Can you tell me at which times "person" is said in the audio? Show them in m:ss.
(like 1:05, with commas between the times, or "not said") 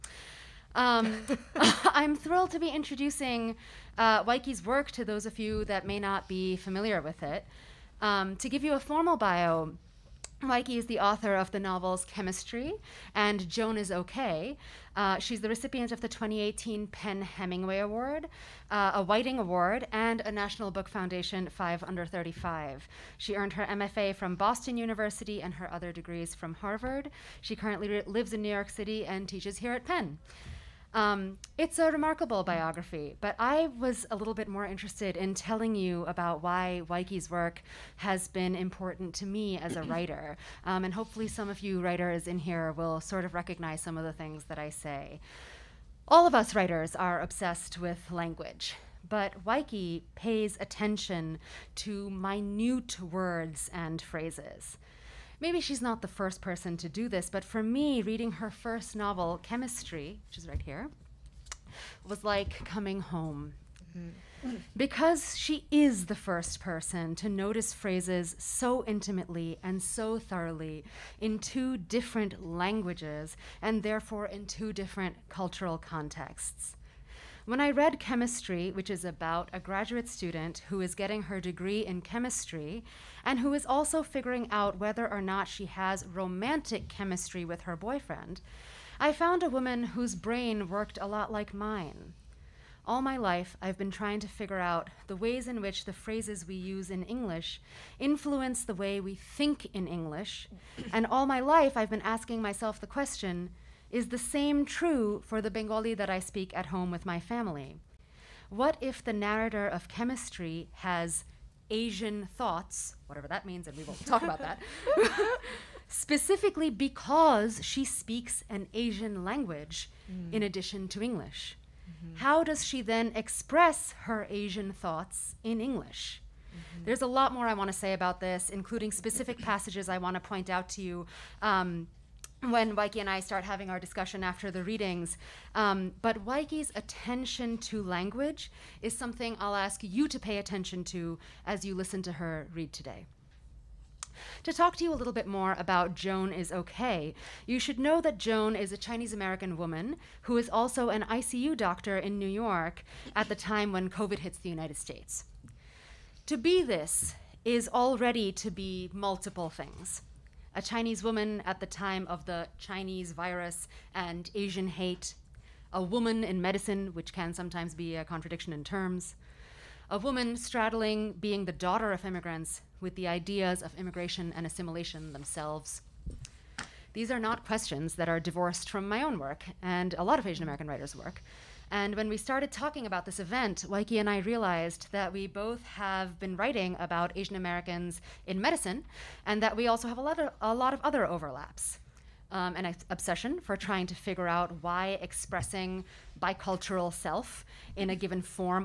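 0:56, 1:06.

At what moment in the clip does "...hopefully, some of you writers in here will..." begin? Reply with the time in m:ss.
0:40.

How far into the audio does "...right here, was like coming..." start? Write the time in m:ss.
1:00.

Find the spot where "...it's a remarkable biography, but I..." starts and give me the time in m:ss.
0:31.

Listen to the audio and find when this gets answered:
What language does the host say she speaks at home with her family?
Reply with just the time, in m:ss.
1:45.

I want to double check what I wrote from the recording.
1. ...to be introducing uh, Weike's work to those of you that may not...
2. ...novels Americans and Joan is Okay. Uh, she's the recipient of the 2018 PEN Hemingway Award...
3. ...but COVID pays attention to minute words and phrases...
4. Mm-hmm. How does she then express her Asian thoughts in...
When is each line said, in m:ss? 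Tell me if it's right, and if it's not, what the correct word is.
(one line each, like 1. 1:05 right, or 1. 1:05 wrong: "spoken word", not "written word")
1. 0:02 right
2. 0:11 wrong: "Chemistry", not "Americans"
3. 0:49 wrong: "Waiki", not "COVID"
4. 2:01 right.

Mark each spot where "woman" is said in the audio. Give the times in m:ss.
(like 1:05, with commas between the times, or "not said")
1:29, 2:29, 2:41, 2:45, 2:49.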